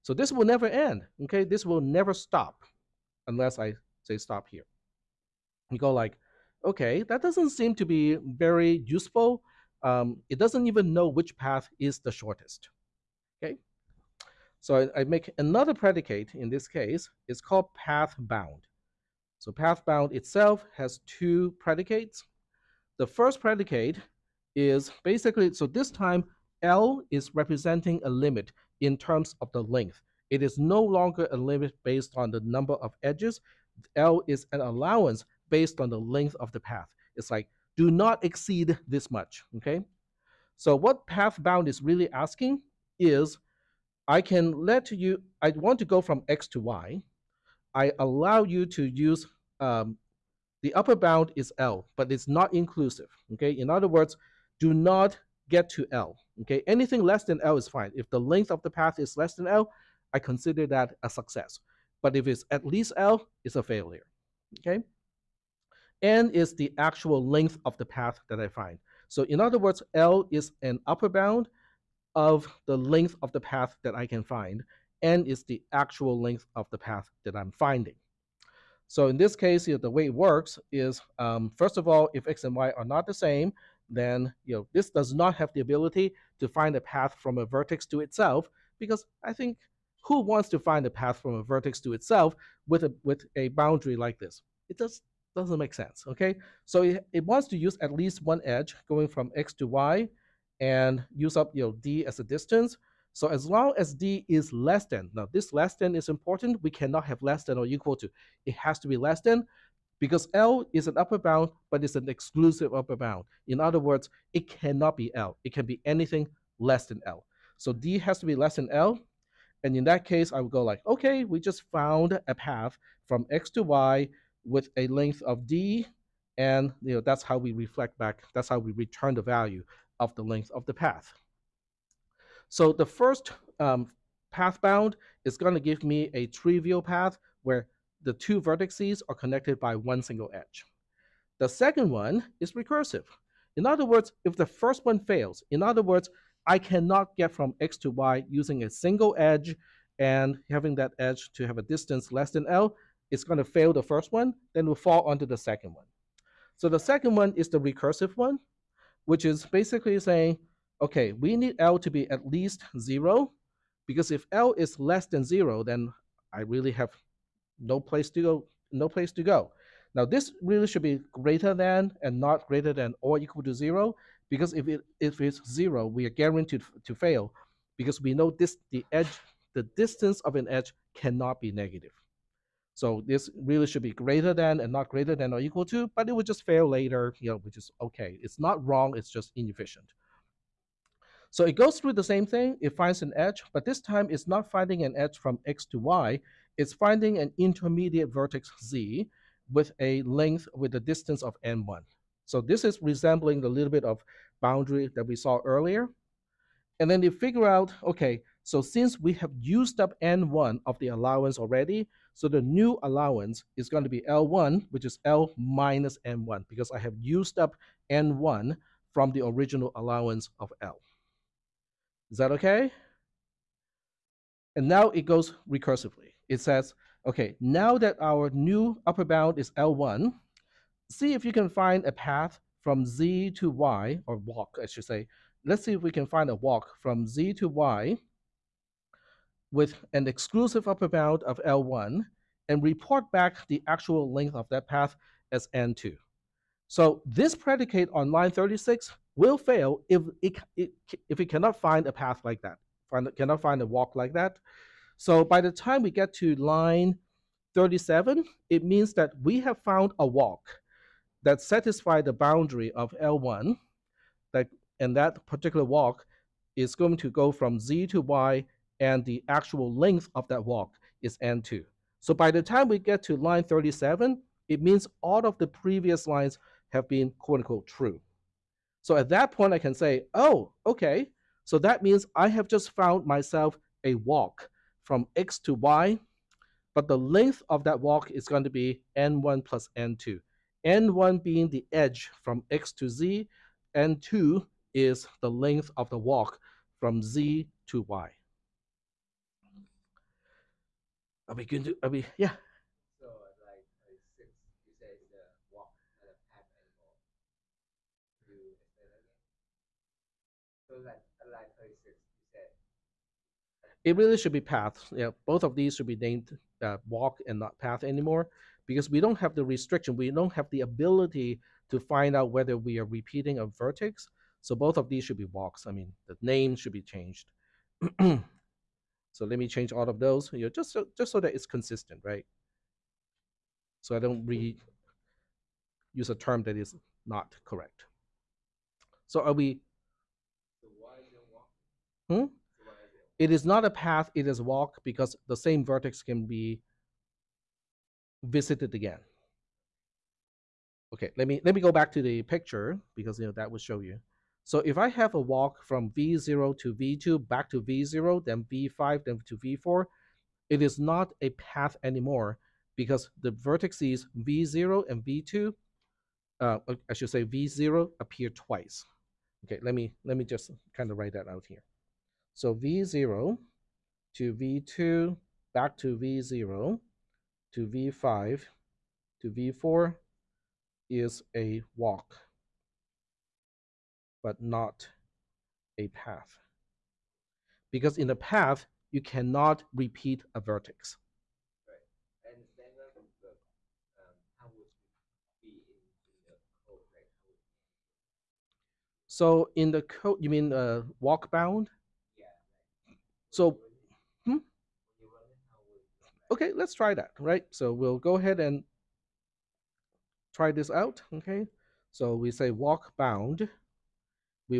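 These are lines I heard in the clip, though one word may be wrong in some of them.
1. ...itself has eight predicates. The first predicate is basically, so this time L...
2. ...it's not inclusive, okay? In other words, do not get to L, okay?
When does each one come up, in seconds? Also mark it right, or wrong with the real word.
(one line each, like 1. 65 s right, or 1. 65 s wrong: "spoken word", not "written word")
1. 20 s wrong: "two", not "eight"
2. 52 s right.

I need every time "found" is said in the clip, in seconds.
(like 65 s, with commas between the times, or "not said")
121 s, 259 s, 282 s.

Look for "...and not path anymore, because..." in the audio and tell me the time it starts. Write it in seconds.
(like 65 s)
317 s.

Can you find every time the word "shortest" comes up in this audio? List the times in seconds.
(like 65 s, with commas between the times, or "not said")
12 s.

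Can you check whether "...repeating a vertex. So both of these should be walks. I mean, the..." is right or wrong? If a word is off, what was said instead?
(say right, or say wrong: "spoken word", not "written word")
right.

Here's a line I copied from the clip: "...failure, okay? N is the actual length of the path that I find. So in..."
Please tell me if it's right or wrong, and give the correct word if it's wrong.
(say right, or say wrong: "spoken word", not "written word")
right.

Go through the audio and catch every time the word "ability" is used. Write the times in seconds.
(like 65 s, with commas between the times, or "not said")
85 s, 320 s.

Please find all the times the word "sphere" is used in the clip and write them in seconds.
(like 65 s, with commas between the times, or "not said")
not said.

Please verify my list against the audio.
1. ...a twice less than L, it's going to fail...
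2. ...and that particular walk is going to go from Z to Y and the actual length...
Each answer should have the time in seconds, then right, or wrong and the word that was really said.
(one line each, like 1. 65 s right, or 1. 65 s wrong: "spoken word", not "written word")
1. 151 s wrong: "distance", not "twice"
2. 264 s right.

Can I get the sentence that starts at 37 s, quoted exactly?
It's like, do not exceed this much, okay?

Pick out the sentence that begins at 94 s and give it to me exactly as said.
It just doesn't make sense, okay?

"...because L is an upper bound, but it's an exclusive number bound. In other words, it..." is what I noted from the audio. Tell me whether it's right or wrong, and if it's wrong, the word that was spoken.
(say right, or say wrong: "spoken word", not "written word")
wrong: "upper", not "number".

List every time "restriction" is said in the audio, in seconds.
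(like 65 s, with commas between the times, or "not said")
319 s.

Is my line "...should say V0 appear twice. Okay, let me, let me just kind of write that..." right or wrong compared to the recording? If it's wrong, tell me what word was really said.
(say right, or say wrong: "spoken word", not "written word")
right.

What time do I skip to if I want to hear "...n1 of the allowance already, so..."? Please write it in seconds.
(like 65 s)
210 s.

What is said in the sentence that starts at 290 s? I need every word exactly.
n1 being the edge from x to z, n2 is the length of the walk from z to y.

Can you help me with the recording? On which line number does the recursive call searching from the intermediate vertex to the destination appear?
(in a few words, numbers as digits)
36.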